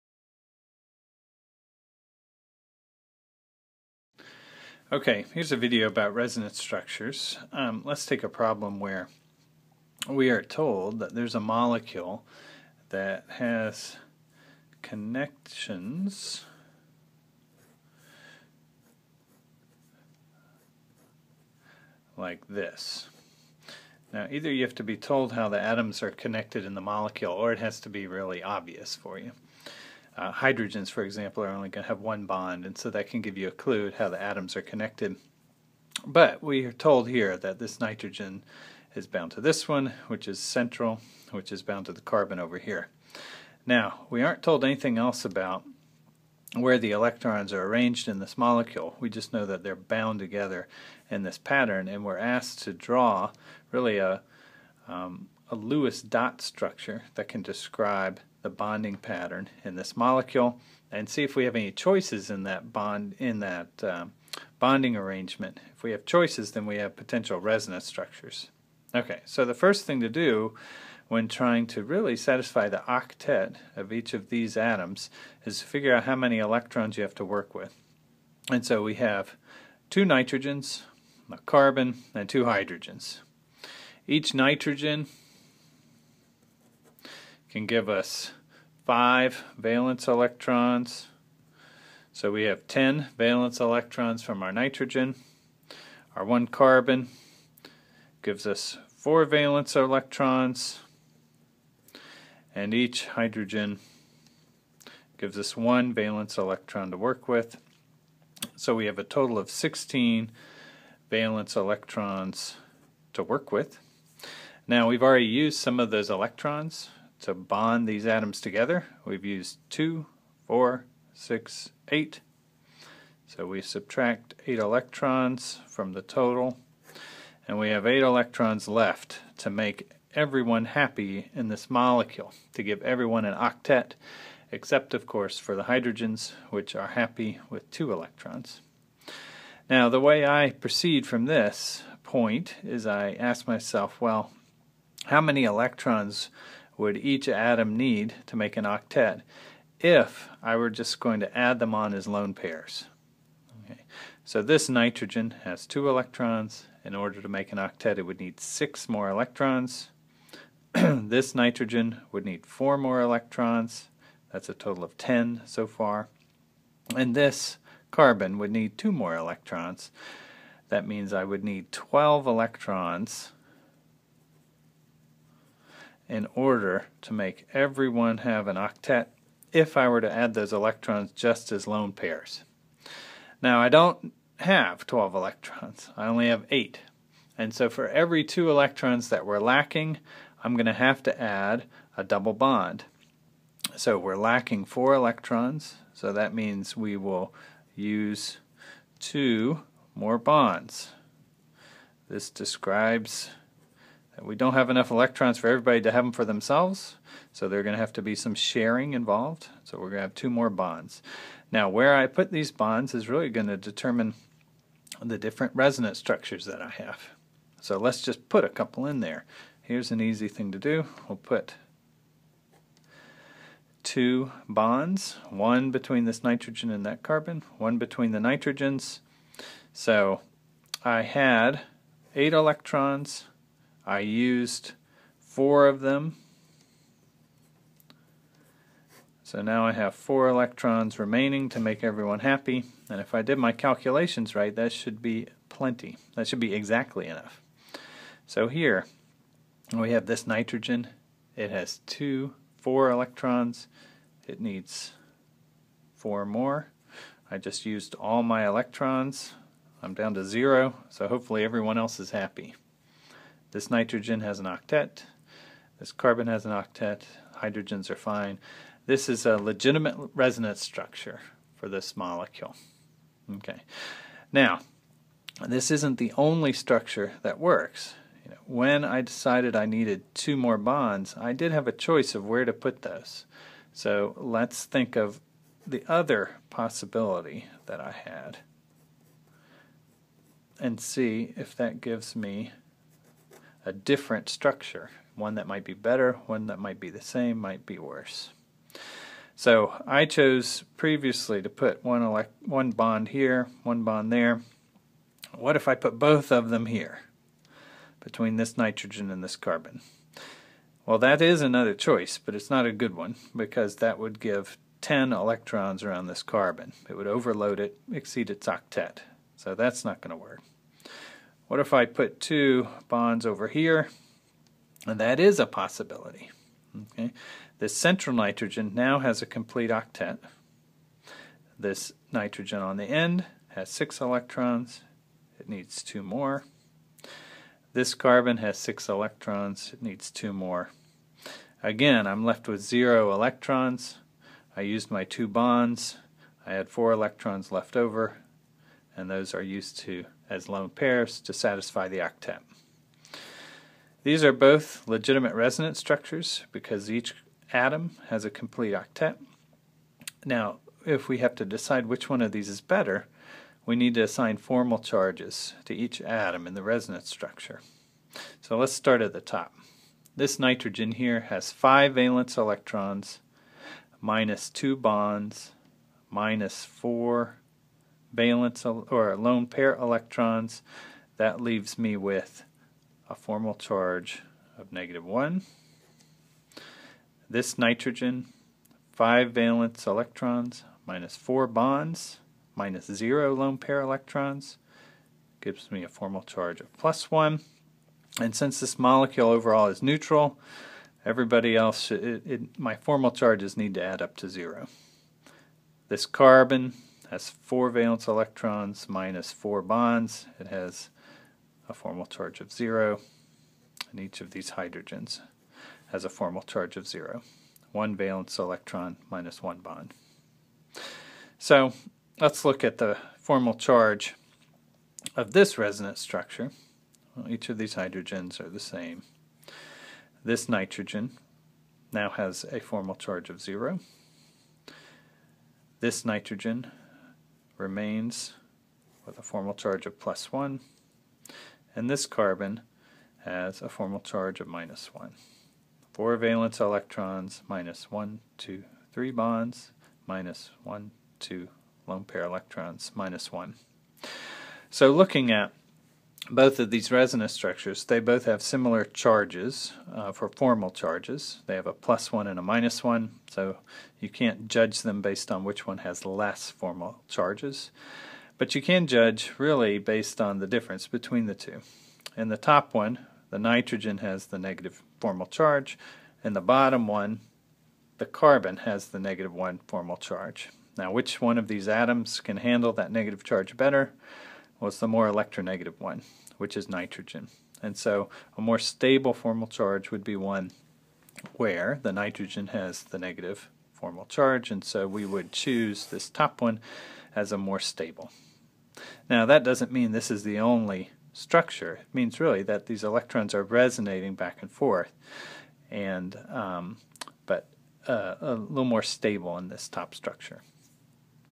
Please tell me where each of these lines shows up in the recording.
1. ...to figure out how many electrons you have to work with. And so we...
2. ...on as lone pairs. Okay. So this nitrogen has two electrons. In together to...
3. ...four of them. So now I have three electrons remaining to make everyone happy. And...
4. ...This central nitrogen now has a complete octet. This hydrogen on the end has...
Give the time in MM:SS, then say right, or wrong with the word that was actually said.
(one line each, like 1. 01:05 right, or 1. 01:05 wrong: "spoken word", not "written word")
1. 01:15 right
2. 02:31 wrong: "order", not "together"
3. 03:55 wrong: "four", not "three"
4. 05:27 wrong: "nitrogen", not "hydrogen".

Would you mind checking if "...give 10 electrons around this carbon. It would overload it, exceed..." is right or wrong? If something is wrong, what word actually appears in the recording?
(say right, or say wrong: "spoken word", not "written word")
right.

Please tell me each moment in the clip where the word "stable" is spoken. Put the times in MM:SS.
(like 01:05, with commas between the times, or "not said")
08:08, 08:17, 08:28.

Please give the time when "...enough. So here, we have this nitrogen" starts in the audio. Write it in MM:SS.
04:07.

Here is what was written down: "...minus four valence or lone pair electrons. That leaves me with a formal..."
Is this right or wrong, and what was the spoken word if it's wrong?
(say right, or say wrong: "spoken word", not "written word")
right.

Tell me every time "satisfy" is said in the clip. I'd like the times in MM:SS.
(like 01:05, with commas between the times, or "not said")
01:12, 05:51.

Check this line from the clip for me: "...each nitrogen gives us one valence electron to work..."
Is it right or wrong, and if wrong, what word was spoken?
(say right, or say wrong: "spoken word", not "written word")
wrong: "hydrogen", not "nitrogen".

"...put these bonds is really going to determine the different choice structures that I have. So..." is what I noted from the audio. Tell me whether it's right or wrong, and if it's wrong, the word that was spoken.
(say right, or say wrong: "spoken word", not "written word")
wrong: "resonance", not "choice".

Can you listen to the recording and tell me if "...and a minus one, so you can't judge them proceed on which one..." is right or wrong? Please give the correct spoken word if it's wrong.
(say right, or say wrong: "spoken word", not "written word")
wrong: "based", not "proceed".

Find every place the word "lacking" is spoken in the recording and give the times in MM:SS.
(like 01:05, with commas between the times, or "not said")
03:09, 03:14.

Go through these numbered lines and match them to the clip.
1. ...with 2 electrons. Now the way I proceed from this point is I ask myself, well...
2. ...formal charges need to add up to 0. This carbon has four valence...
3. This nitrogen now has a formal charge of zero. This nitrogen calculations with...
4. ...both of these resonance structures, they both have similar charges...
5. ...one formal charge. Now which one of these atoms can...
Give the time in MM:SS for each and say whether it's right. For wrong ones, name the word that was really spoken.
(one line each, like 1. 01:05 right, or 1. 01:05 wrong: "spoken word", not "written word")
1. 02:17 right
2. 06:42 right
3. 07:10 wrong: "remains", not "calculations"
4. 07:36 right
5. 07:59 right.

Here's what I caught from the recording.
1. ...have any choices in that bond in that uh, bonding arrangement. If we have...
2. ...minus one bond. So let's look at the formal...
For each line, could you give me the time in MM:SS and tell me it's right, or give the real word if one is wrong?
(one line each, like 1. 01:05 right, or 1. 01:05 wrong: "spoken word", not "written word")
1. 01:01 right
2. 06:59 right.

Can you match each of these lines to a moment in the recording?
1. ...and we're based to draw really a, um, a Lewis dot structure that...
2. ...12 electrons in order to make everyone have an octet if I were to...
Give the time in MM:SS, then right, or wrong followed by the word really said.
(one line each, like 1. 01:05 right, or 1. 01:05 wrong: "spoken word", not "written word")
1. 00:51 wrong: "asked", not "based"
2. 02:51 right.